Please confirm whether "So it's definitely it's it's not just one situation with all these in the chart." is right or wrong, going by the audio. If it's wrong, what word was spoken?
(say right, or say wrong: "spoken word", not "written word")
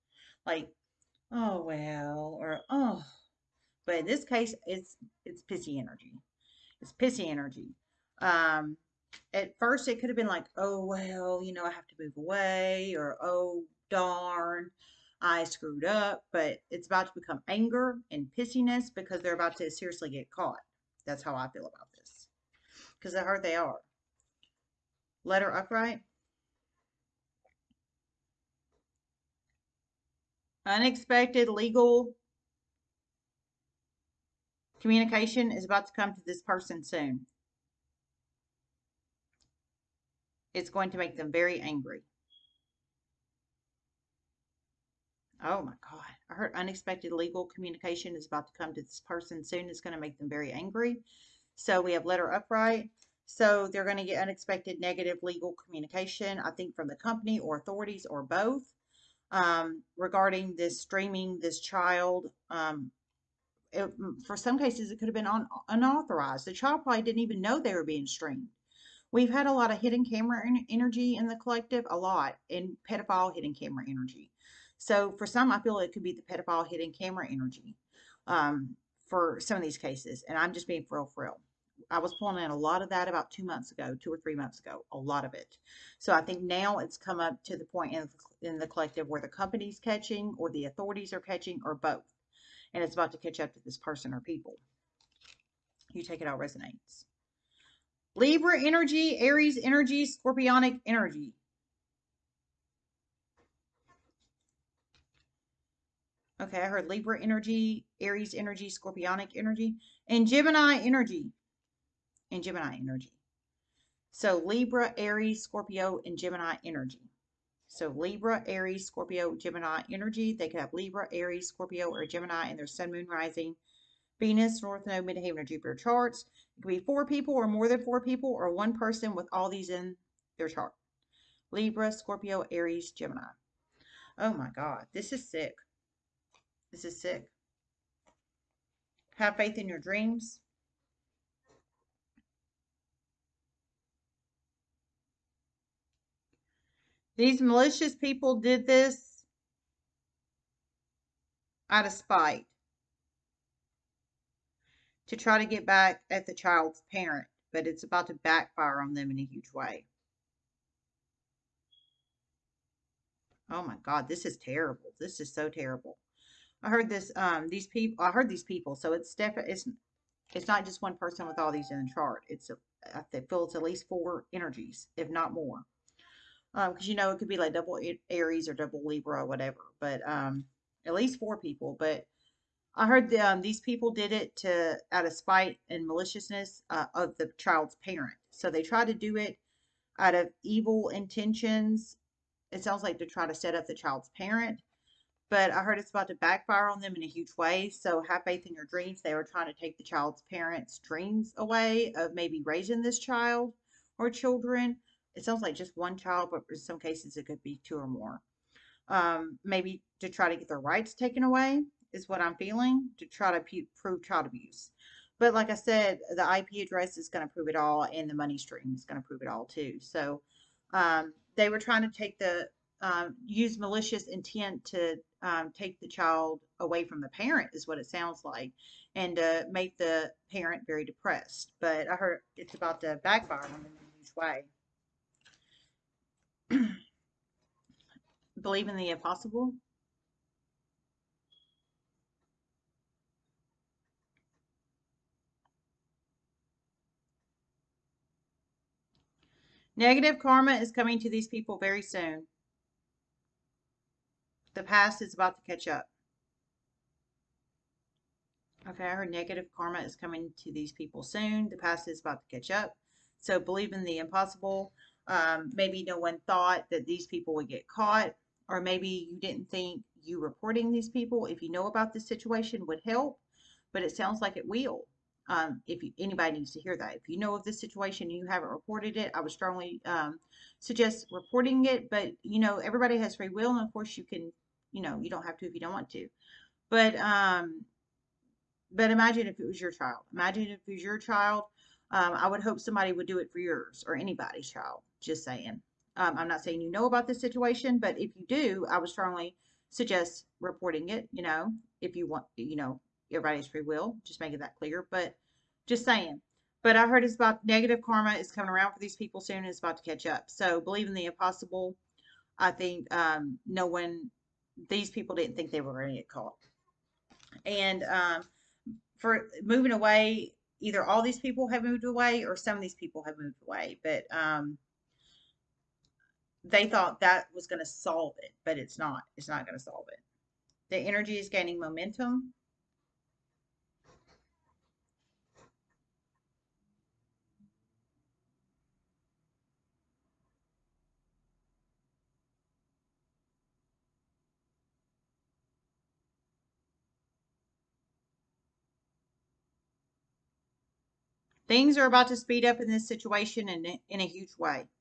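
wrong: "person", not "situation".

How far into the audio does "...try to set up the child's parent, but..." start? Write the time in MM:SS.
03:13.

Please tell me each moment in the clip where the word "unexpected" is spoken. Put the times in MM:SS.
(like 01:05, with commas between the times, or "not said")
00:30, 00:46, 00:54.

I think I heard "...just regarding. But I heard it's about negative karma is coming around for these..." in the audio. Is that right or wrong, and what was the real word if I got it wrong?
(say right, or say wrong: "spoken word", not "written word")
wrong: "saying", not "regarding".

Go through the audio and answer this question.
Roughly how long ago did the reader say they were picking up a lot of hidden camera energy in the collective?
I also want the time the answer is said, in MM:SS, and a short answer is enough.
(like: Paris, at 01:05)
About two months ago, at 01:23.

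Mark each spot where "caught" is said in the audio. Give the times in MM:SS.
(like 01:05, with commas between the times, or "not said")
00:20, 04:27, 05:16.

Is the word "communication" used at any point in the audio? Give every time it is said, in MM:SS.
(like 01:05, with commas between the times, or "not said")
00:34, 00:47, 00:55.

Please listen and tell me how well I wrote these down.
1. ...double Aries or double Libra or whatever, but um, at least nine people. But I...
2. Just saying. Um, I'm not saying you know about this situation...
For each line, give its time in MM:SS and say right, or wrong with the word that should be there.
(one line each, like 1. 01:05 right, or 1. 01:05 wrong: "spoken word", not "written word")
1. 02:57 wrong: "four", not "nine"
2. 04:55 right.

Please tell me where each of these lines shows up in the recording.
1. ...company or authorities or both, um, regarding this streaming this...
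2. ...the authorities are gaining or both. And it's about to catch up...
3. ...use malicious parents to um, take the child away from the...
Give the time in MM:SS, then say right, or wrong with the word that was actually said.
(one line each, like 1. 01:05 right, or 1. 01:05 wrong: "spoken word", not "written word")
1. 00:56 right
2. 01:30 wrong: "catching", not "gaining"
3. 03:43 wrong: "intent", not "parents".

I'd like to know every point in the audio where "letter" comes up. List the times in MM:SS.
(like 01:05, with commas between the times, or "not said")
00:25, 00:52.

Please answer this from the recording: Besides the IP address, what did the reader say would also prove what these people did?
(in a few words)
The money stream.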